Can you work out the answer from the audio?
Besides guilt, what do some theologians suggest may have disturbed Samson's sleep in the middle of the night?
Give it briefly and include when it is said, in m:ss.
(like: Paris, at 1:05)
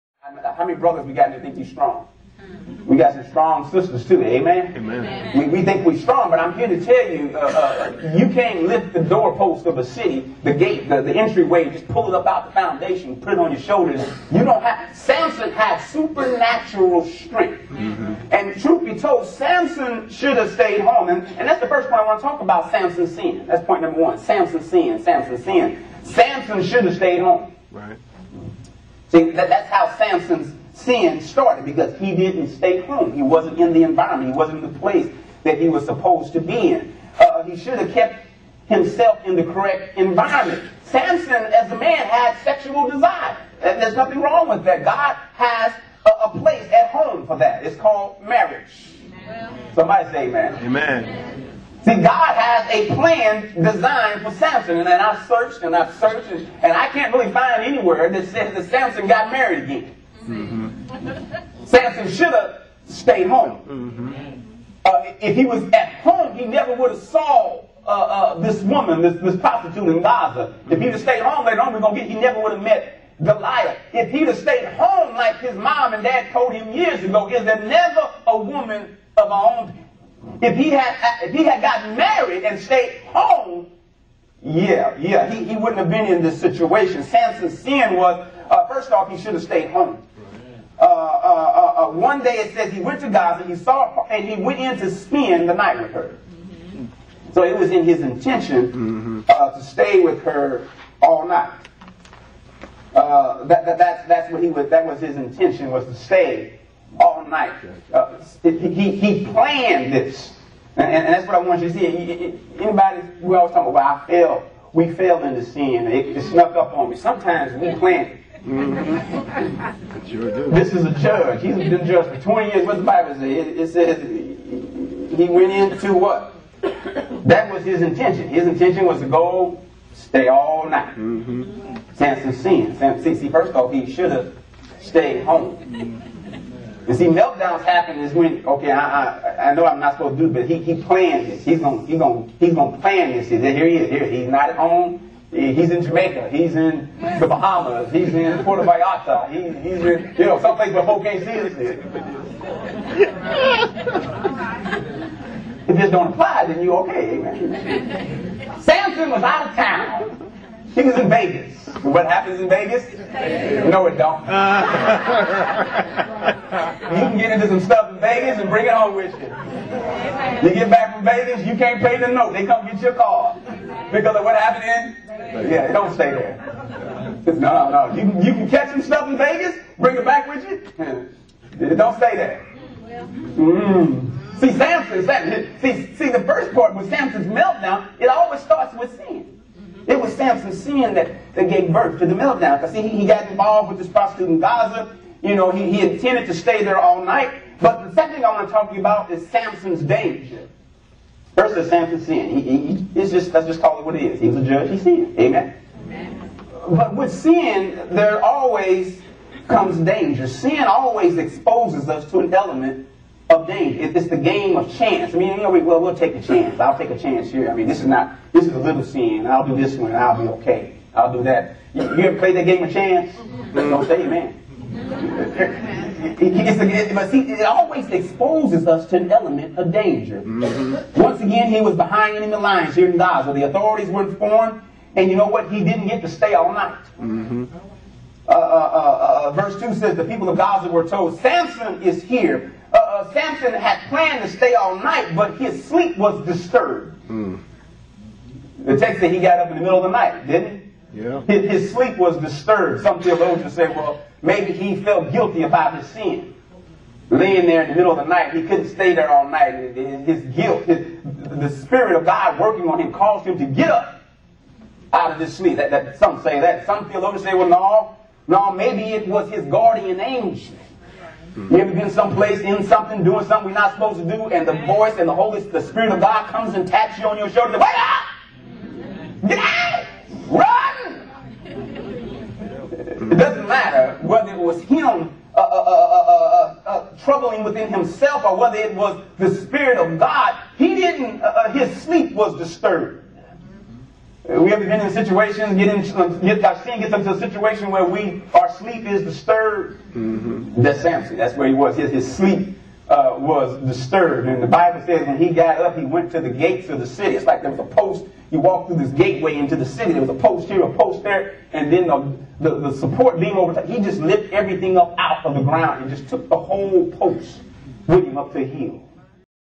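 his guardian angel, at 4:29.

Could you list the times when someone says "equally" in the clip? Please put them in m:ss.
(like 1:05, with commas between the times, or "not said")
not said.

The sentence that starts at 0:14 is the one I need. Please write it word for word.
You don't have, Samson had supernatural strength.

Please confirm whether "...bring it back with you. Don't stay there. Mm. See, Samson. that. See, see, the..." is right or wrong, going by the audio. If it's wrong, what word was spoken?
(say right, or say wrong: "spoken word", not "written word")
right.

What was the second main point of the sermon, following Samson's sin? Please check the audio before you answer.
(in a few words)
Samson's danger.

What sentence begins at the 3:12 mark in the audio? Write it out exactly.
Because see, he, he got involved with this prostitute in Gaza.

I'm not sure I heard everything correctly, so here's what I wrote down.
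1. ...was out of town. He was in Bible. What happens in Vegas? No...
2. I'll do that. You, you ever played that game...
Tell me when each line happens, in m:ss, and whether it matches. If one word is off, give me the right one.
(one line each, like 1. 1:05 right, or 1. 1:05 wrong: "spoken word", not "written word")
1. 2:39 wrong: "Vegas", not "Bible"
2. 3:40 right.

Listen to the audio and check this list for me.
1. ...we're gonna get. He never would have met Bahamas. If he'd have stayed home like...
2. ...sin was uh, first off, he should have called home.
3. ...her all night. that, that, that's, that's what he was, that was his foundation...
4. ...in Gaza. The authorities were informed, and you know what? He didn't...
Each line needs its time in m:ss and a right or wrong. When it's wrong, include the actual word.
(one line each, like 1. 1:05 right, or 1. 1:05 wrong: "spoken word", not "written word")
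1. 1:11 wrong: "Delilah", not "Bahamas"
2. 1:27 wrong: "stayed", not "called"
3. 1:40 wrong: "intention", not "foundation"
4. 3:52 right.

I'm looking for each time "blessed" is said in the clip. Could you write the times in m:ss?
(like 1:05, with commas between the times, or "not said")
not said.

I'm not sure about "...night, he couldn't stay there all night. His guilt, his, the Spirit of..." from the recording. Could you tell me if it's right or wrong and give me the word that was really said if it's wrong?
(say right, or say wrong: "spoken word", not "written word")
right.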